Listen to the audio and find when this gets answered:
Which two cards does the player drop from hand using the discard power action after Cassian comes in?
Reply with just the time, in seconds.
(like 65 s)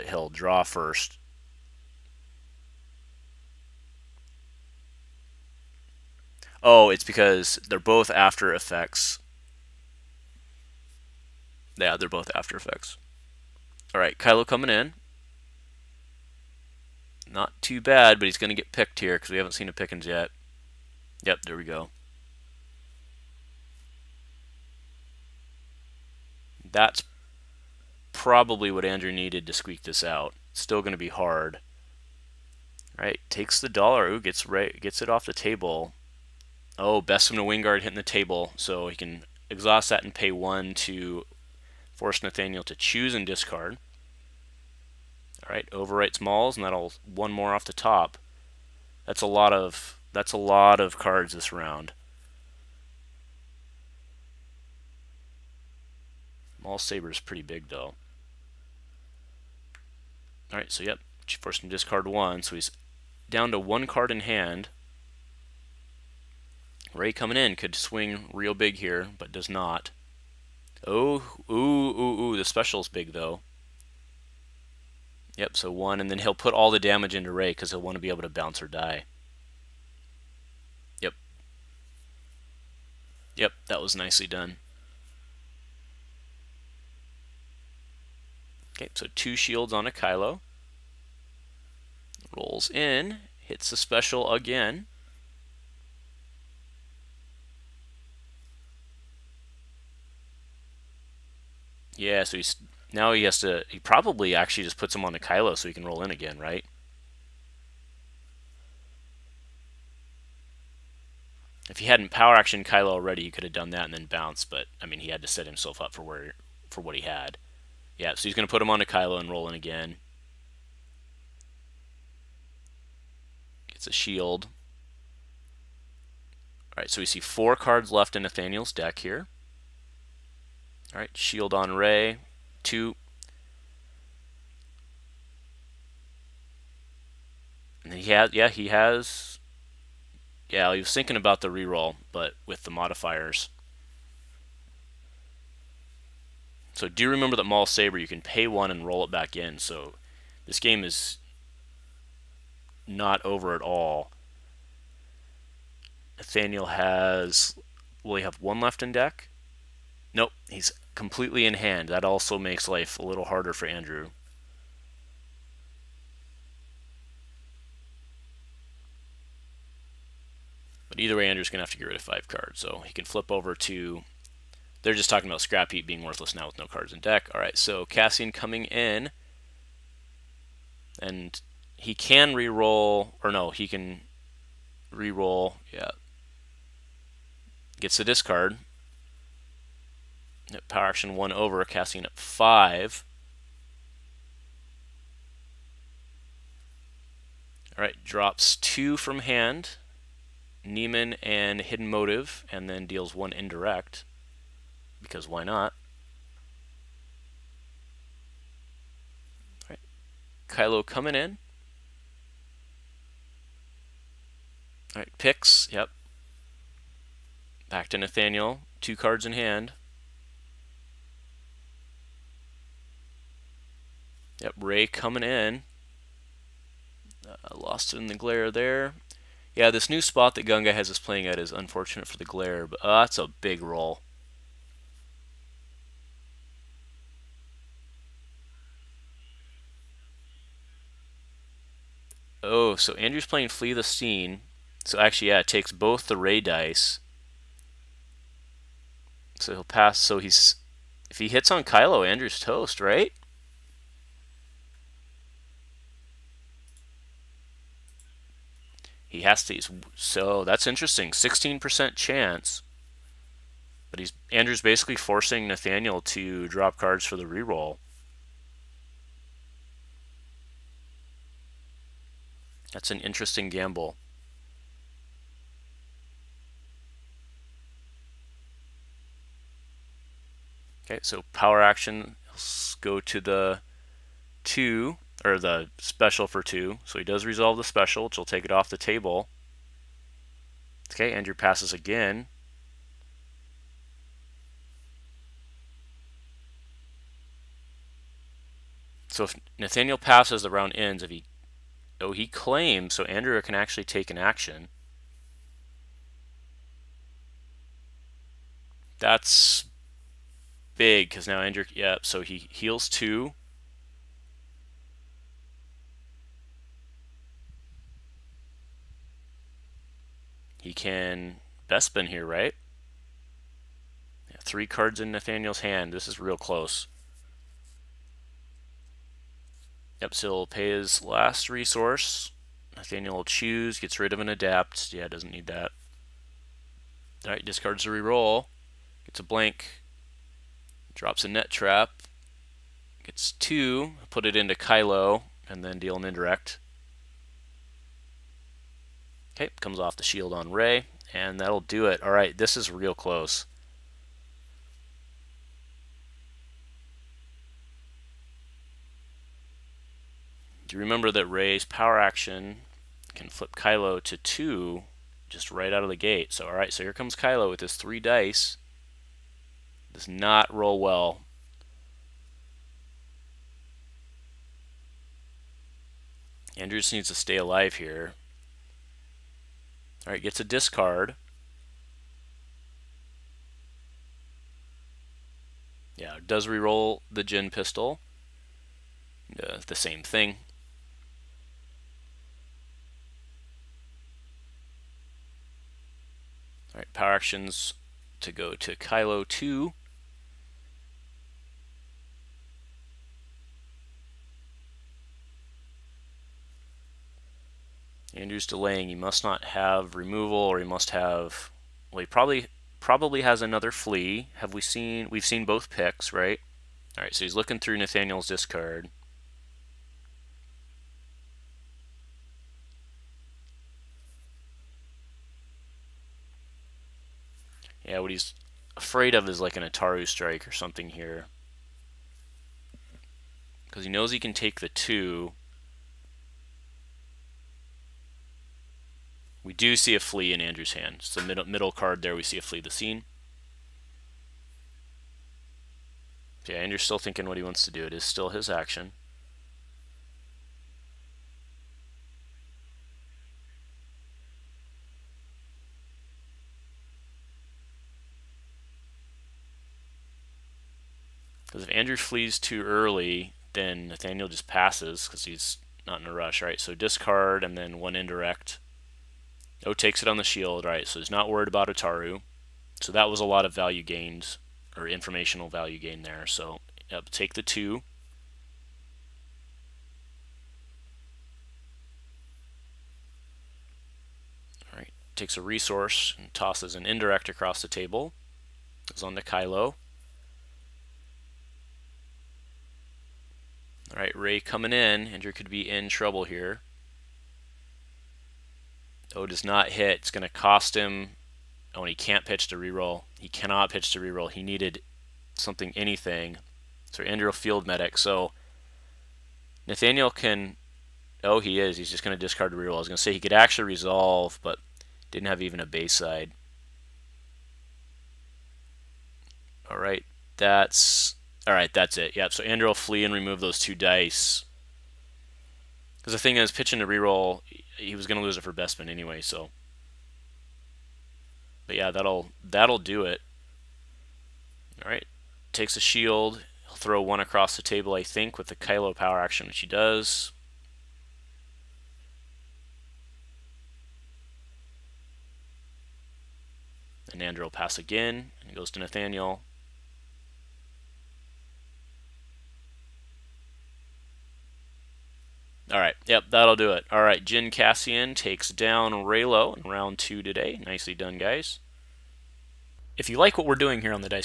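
200 s.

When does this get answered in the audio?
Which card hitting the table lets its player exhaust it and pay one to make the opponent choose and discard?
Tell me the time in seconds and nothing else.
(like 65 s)
37 s.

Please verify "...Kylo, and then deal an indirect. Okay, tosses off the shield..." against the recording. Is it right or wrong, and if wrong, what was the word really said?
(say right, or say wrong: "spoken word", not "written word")
wrong: "comes", not "tosses".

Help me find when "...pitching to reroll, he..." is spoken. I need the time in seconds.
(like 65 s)
526 s.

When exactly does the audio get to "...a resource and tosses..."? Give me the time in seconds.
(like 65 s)
485 s.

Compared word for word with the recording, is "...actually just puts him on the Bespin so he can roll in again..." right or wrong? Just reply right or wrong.
wrong.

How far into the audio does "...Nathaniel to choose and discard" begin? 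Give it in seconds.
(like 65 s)
42 s.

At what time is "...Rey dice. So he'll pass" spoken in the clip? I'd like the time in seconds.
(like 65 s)
246 s.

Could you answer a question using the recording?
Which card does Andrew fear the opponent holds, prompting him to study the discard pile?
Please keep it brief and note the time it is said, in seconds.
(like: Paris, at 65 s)
Ataru strike, at 429 s.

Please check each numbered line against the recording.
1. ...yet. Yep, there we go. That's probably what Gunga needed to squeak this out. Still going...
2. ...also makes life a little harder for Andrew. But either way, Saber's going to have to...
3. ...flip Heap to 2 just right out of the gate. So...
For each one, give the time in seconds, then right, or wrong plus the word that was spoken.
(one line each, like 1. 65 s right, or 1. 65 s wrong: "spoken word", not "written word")
1. 20 s wrong: "Andrew", not "Gunga"
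2. 162 s wrong: "Andrew", not "Saber"
3. 363 s wrong: "Kylo", not "Heap".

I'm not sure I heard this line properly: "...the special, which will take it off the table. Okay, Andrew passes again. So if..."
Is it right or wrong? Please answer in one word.
right.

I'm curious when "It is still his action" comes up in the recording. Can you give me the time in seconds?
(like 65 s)
447 s.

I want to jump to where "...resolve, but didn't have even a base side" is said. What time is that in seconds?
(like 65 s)
513 s.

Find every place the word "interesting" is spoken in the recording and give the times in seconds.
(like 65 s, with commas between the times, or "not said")
260 s, 272 s.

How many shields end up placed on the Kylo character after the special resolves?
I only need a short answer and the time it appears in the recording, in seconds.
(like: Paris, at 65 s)
2, at 89 s.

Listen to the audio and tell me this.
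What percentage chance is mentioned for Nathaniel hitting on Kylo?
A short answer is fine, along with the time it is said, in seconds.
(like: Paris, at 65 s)
16%, at 261 s.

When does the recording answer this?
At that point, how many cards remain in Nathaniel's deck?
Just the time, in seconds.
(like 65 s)
127 s.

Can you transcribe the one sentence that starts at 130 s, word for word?
All right, shield on Rey, two.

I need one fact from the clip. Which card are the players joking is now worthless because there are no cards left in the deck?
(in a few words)
Scrap Heap.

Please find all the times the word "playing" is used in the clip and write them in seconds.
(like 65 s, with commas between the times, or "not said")
230 s, 243 s.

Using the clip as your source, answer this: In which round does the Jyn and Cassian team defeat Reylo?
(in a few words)
Round 2.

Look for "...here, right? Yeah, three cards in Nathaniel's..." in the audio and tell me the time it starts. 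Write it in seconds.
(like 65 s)
322 s.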